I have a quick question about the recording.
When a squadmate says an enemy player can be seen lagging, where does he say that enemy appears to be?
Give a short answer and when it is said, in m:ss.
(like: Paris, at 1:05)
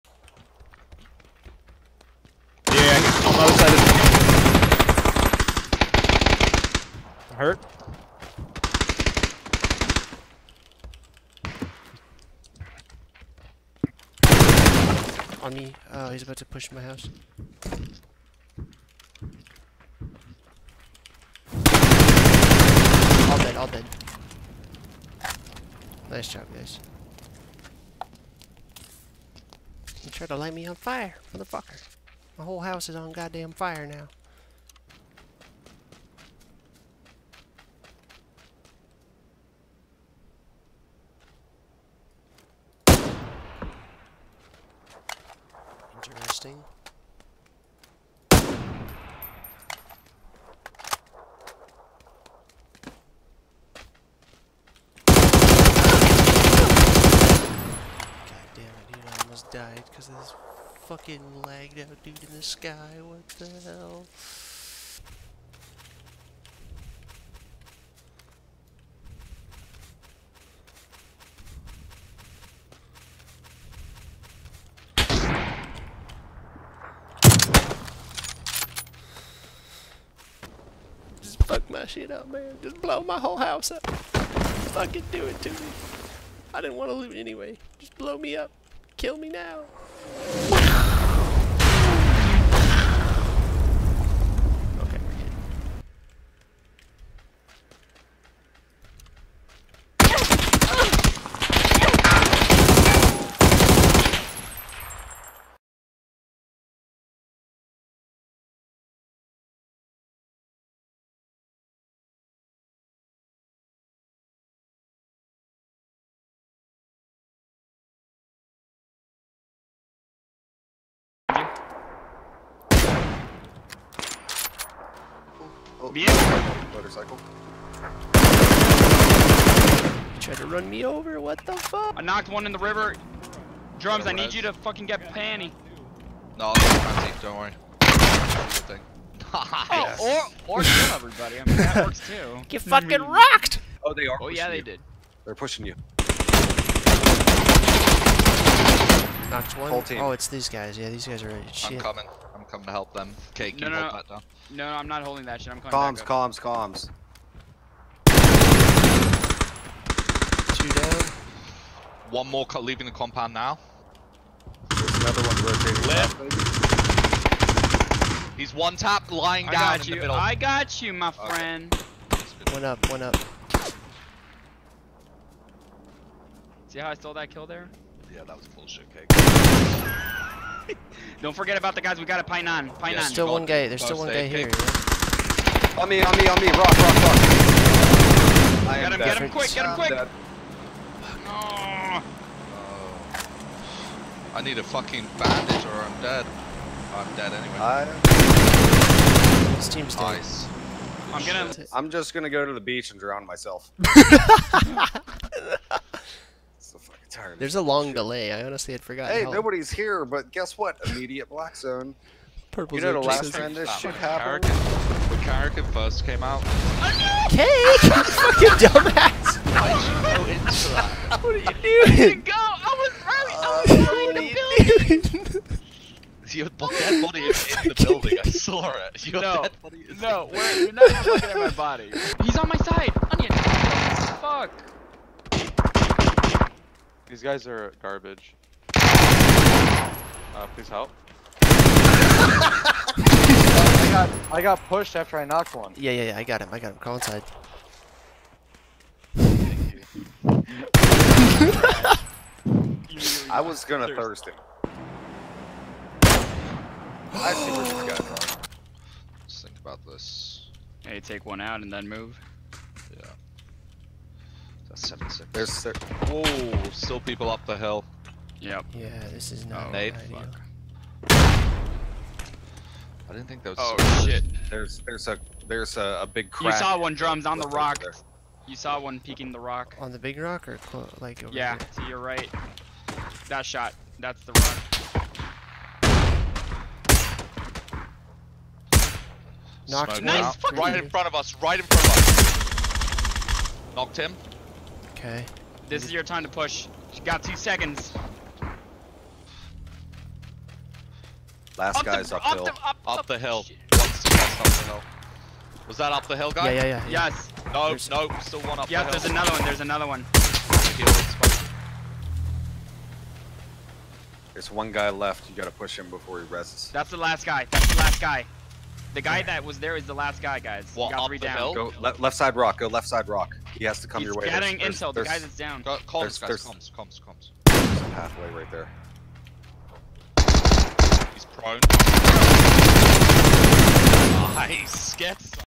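In the sky, at 1:02.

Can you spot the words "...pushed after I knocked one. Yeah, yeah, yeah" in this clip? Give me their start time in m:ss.
4:04.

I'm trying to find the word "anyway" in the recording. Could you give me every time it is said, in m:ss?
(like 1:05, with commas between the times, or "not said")
1:27, 3:17.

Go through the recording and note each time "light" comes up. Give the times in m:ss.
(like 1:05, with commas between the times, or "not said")
0:30.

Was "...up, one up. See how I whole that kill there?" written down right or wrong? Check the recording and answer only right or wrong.
wrong.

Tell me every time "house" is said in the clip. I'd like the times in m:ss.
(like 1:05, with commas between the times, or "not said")
0:16, 0:32, 1:23.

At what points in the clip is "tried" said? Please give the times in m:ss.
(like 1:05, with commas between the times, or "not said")
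0:30, 2:10.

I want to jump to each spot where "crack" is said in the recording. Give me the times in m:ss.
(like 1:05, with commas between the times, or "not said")
4:36.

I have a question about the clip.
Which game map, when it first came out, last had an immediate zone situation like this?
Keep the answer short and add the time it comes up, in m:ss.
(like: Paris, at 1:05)
Karakin, at 3:35.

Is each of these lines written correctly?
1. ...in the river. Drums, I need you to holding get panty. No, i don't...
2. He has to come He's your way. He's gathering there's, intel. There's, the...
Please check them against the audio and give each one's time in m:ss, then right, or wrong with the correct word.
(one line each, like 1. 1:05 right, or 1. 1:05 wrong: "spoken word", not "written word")
1. 2:12 wrong: "fucking", not "holding"
2. 5:23 right.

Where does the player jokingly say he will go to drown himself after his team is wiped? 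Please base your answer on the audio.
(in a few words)
The beach.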